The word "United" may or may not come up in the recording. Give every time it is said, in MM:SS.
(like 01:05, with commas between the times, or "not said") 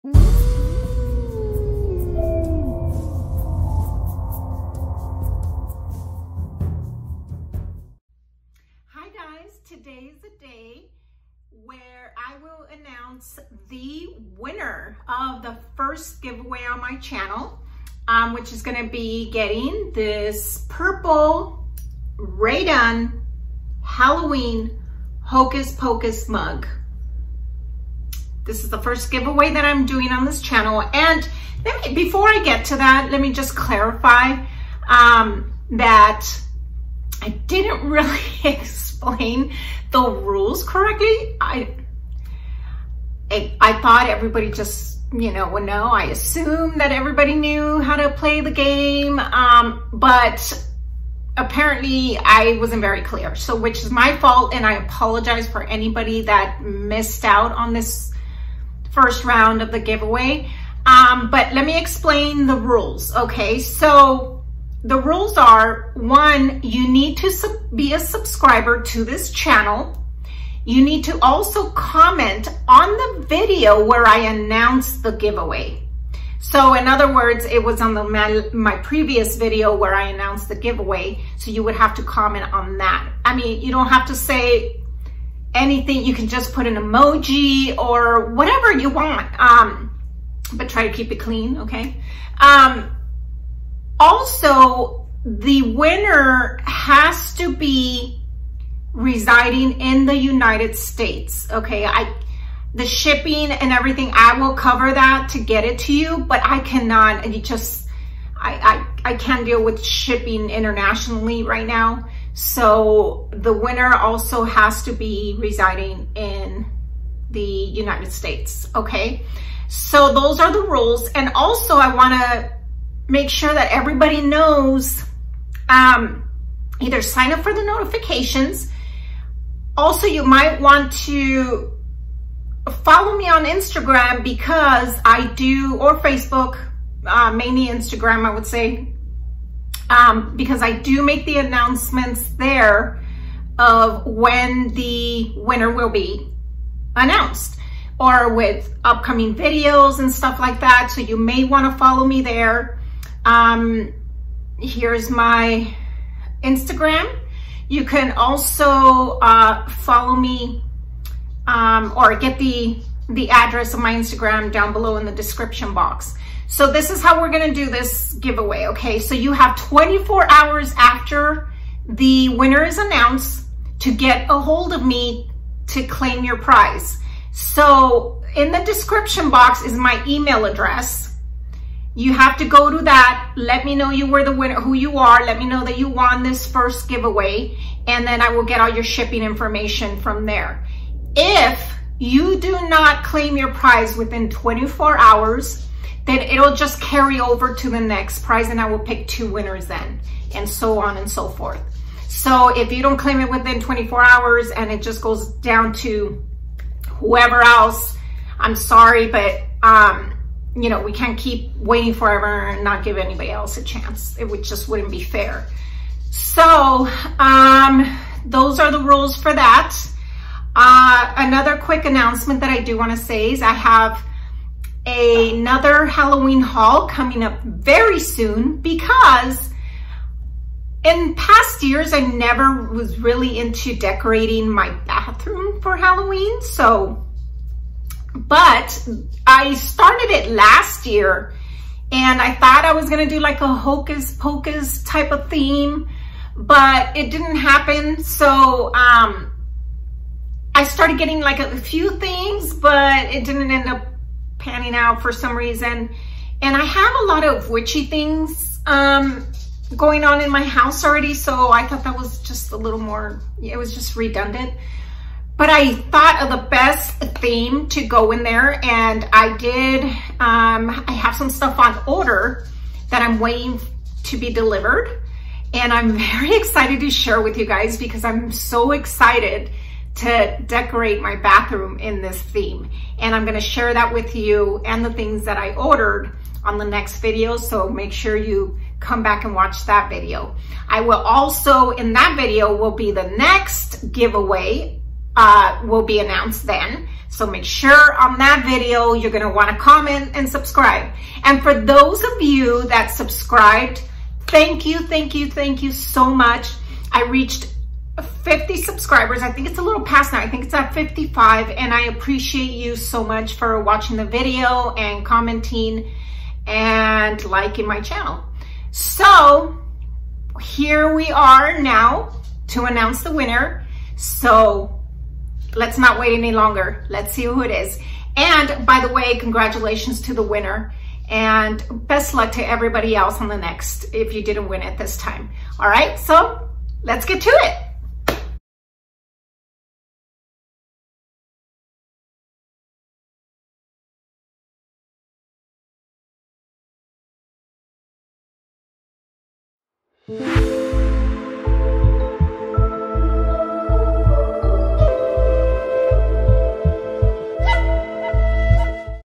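01:40, 01:57.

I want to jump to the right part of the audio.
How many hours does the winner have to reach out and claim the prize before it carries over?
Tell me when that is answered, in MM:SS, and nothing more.
02:49.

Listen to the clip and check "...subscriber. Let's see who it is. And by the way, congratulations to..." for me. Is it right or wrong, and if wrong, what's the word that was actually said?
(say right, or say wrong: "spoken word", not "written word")
wrong: "longer", not "subscriber".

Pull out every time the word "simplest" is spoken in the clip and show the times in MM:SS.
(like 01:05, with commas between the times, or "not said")
not said.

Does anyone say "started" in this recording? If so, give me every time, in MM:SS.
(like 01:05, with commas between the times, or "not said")
03:59, 04:10.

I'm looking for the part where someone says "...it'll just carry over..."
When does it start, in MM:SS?
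03:16.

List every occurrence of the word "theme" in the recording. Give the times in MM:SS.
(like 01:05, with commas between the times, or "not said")
04:05, 04:27, 04:42.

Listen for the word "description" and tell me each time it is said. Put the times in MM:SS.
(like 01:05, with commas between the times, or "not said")
02:45, 02:58.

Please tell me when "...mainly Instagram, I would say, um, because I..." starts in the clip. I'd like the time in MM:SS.
02:17.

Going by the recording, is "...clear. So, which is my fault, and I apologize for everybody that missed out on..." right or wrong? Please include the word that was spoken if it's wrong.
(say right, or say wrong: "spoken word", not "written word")
wrong: "anybody", not "everybody".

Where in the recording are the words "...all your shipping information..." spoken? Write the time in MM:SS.
03:08.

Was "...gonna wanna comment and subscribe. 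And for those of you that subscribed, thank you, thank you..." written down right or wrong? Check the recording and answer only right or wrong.
right.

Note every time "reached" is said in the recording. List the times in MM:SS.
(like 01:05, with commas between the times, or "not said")
05:07.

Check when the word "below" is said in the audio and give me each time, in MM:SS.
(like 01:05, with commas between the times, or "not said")
02:44.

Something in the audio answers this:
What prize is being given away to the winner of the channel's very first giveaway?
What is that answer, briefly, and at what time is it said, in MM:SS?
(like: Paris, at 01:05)
Purple Rae Dunn Halloween Hocus Pocus mug, at 00:20.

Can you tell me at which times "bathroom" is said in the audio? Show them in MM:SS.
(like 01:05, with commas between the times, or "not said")
03:54, 04:41.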